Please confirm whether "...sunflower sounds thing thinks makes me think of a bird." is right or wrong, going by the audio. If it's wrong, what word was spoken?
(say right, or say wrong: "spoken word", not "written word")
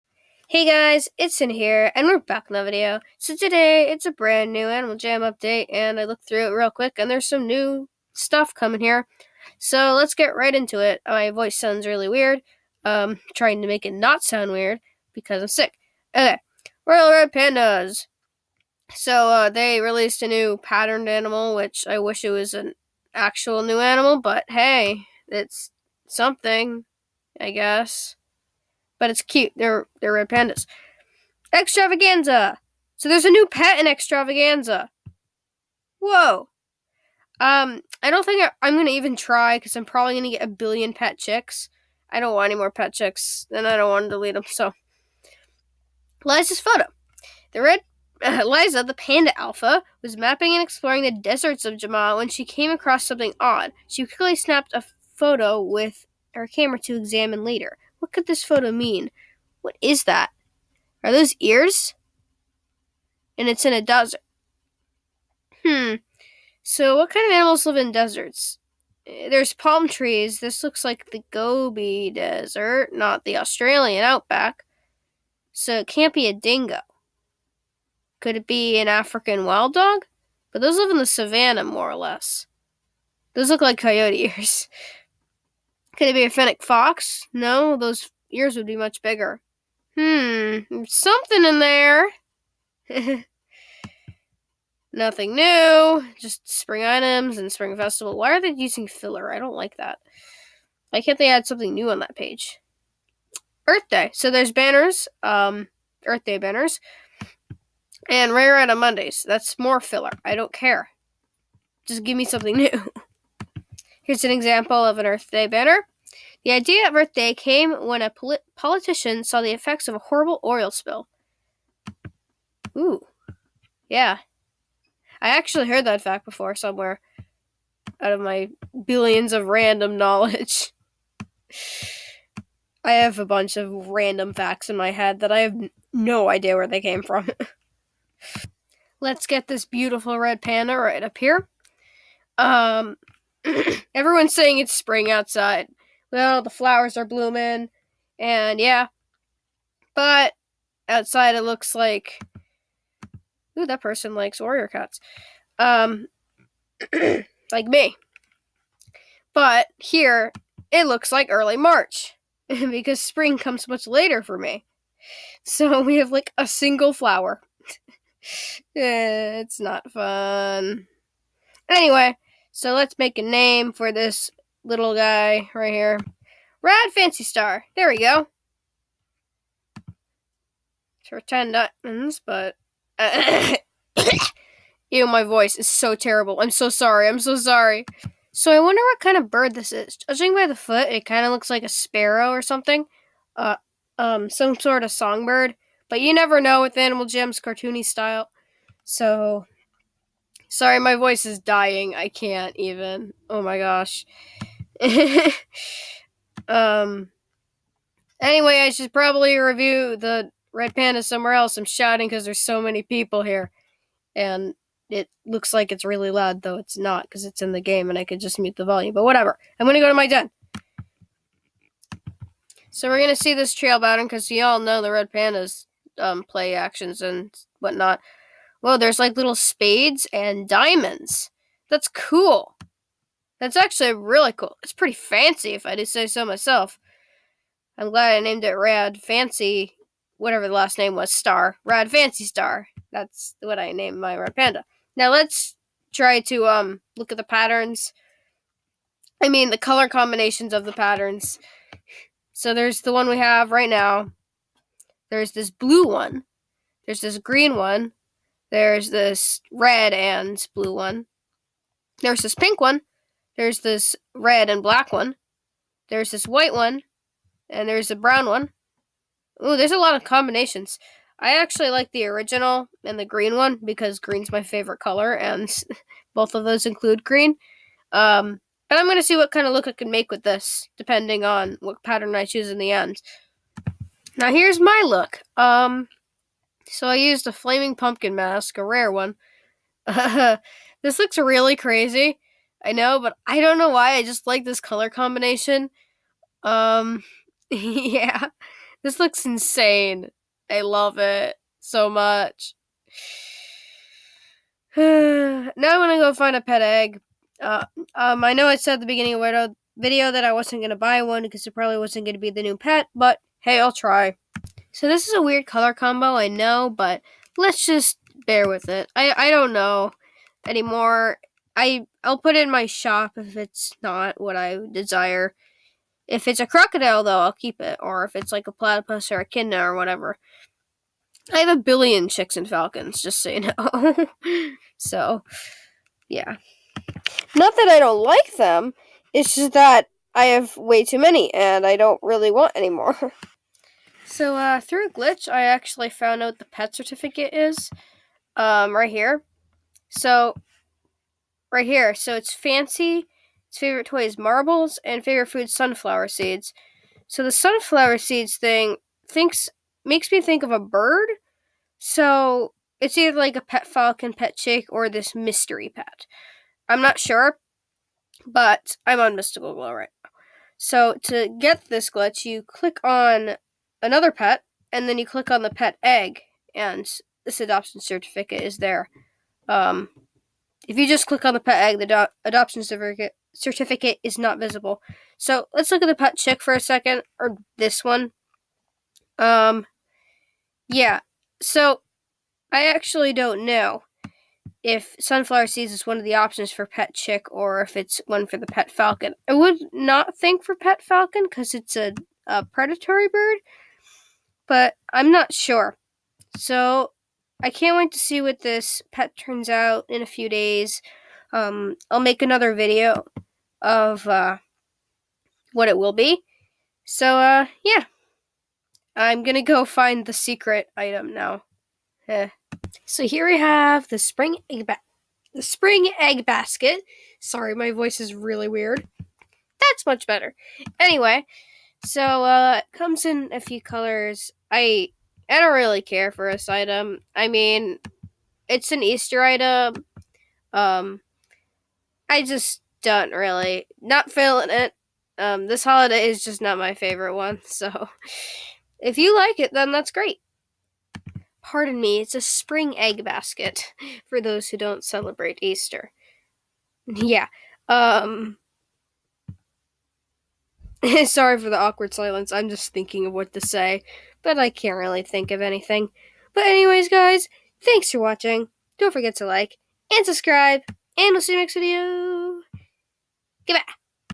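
wrong: "seeds", not "sounds".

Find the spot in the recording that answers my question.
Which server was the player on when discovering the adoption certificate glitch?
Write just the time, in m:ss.
6:09.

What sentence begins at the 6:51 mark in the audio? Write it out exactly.
Um, I'll make another video of uh, what it will be.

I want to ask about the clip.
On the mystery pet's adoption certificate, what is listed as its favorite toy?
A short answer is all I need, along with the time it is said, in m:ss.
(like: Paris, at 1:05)
marbles, at 5:54.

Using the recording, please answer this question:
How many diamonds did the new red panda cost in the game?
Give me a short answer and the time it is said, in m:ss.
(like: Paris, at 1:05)
10, at 3:01.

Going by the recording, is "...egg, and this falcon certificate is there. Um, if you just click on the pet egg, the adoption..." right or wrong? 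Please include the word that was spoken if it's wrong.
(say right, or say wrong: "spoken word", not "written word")
wrong: "adoption", not "falcon".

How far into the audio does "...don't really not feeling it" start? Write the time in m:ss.
7:22.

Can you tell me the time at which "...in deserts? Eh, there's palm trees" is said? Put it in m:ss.
1:07.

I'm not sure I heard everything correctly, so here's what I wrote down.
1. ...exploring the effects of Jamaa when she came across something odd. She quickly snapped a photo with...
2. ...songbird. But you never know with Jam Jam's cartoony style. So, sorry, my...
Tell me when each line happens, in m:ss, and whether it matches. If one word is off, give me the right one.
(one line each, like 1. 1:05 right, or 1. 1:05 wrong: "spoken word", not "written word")
1. 0:50 wrong: "deserts", not "effects"
2. 3:14 wrong: "Animal", not "Jam".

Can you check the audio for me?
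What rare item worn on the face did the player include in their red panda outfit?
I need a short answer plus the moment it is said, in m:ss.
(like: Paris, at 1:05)
flaming pumpkin mask, at 4:47.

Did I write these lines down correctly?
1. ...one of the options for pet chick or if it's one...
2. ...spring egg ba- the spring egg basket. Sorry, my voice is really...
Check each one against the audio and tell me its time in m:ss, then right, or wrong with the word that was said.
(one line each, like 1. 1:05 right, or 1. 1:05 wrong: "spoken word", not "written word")
1. 6:35 right
2. 7:03 right.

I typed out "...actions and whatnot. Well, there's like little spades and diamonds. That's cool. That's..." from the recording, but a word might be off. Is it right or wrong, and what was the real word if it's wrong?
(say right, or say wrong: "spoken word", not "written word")
right.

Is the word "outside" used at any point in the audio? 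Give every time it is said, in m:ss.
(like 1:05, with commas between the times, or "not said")
2:25, 2:30.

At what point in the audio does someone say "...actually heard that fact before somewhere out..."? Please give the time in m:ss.
2:05.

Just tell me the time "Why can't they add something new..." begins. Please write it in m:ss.
1:40.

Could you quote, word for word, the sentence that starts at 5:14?
So this is a weird color combo, I know, but let's just bear with it.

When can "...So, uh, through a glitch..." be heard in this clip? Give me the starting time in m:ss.
5:44.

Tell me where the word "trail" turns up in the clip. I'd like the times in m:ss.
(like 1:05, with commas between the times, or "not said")
3:43.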